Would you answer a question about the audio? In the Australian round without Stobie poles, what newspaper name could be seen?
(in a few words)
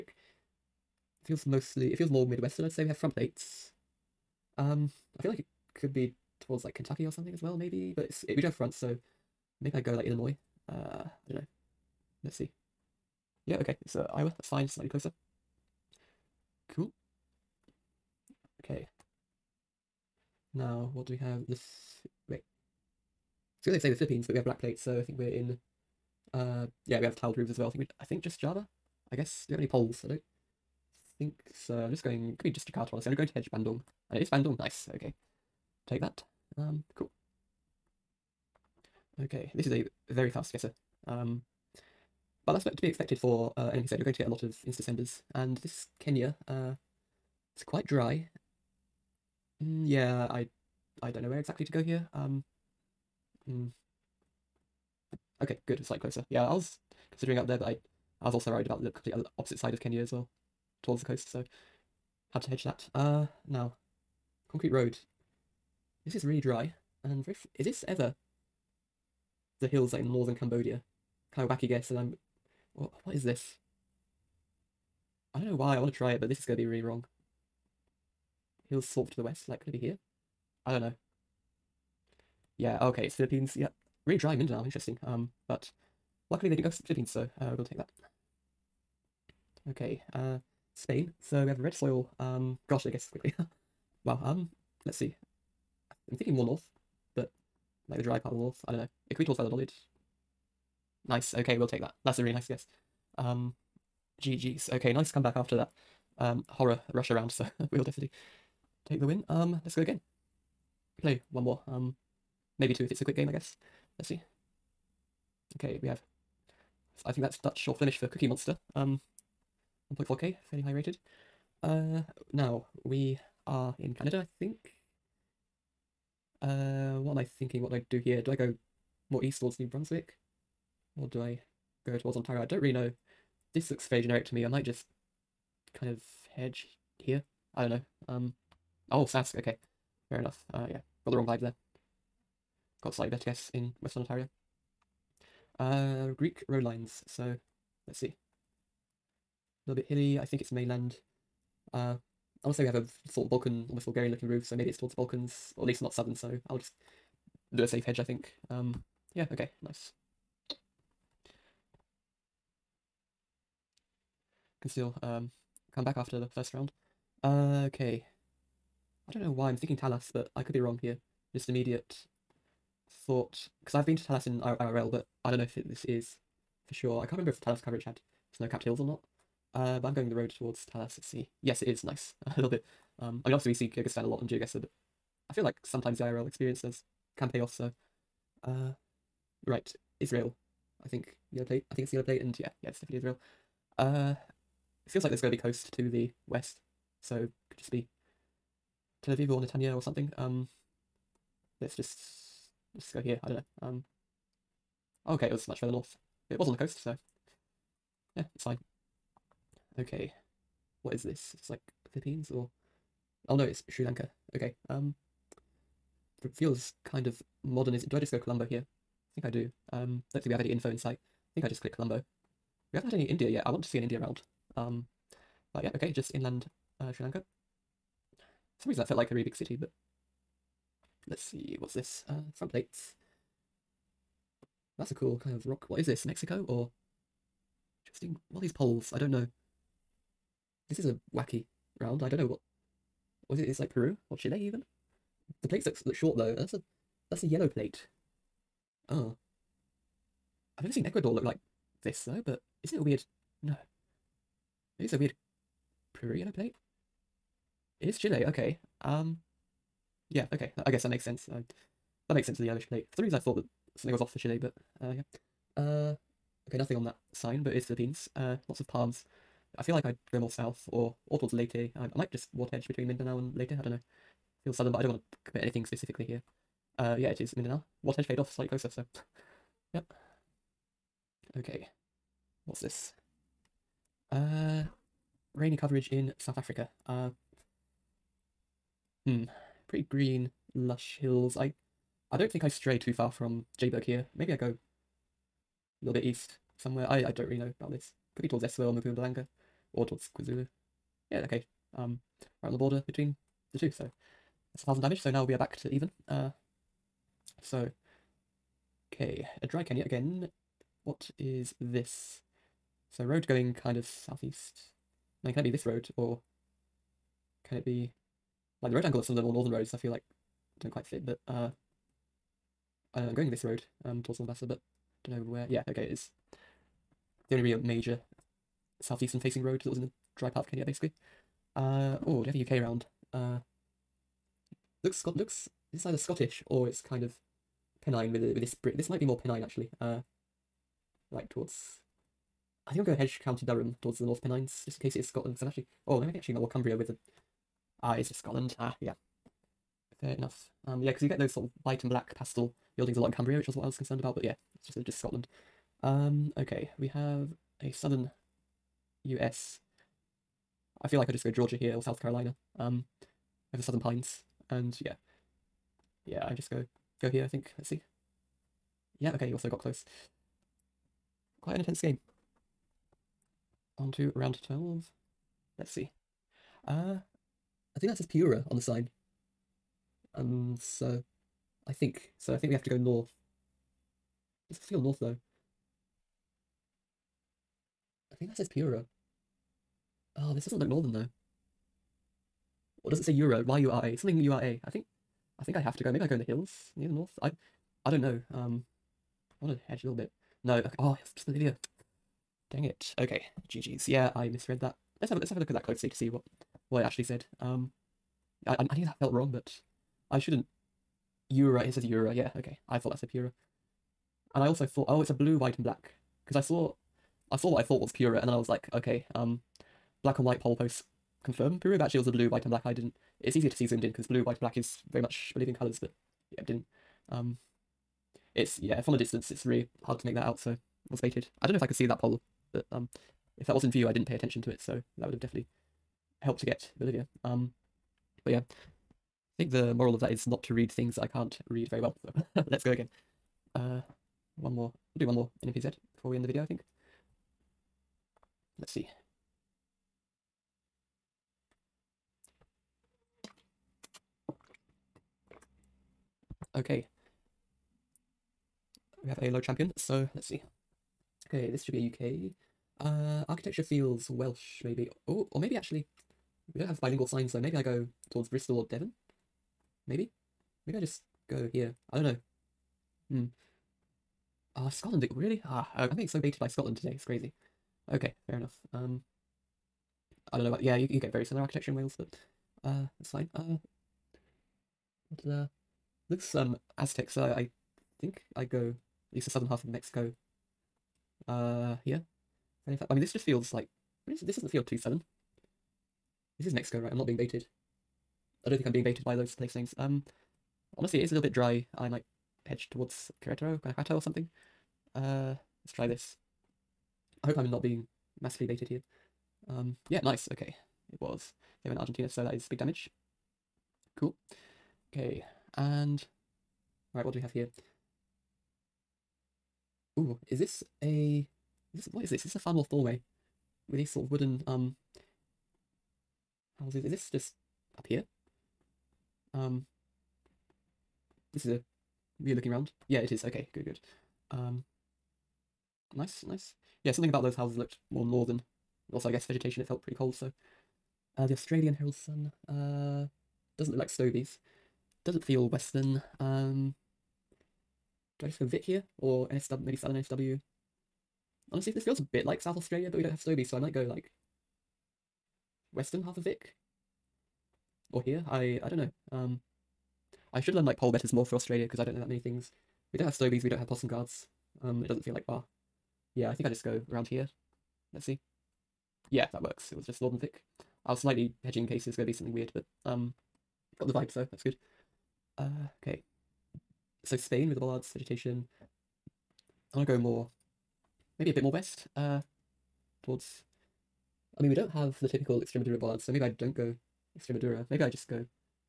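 Herald Sun.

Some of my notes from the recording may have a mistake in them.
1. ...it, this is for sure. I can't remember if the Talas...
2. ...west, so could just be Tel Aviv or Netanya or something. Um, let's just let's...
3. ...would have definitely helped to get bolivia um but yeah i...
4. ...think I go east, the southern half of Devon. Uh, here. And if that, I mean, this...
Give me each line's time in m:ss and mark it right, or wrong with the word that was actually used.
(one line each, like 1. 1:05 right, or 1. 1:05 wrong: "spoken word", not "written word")
1. 2:55 right
2. 3:16 right
3. 7:15 right
4. 8:08 wrong: "Mexico", not "Devon".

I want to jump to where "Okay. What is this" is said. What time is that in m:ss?
3:29.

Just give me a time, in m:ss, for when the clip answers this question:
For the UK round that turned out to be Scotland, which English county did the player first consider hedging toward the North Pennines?
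5:43.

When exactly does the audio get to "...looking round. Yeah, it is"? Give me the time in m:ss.
8:52.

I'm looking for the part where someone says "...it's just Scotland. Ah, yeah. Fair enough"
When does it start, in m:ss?
5:47.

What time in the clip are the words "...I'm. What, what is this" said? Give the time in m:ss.
1:11.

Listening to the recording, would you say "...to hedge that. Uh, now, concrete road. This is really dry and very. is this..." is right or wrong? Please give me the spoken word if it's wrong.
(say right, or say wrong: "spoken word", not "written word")
right.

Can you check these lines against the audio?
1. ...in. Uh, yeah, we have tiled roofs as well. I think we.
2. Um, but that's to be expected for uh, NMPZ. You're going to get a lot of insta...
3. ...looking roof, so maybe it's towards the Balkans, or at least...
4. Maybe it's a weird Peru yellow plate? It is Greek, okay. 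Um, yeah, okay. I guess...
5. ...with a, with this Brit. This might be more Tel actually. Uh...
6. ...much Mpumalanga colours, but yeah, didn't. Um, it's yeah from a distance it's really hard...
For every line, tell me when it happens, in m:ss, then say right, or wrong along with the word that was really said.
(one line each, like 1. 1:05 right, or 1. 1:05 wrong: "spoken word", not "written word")
1. 0:25 right
2. 0:41 right
3. 2:34 right
4. 4:14 wrong: "Chile", not "Greek"
5. 5:38 wrong: "Pennine", not "Tel"
6. 7:05 wrong: "Bolivian", not "Mpumalanga".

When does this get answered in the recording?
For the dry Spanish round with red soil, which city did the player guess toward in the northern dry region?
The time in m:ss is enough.
1:39.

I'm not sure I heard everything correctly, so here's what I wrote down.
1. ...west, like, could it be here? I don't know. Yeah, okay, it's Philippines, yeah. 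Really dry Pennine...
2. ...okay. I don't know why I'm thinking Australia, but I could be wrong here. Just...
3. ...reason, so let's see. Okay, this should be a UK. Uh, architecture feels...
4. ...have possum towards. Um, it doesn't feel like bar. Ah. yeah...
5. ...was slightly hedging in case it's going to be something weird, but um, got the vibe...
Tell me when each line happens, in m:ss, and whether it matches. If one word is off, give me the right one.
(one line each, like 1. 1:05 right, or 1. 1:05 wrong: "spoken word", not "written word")
1. 1:19 wrong: "Mindanao", not "Pennine"
2. 2:47 wrong: "Talas", not "Australia"
3. 7:39 wrong: "champion", not "reason"
4. 9:23 wrong: "guards", not "towards"
5. 9:30 right.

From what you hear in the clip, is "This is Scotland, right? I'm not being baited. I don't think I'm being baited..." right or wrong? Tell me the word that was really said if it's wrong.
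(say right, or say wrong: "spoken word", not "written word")
wrong: "Mexico", not "Scotland".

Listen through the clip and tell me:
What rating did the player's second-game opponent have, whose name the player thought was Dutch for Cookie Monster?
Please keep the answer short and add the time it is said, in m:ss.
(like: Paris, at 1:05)
1.4k, at 1:59.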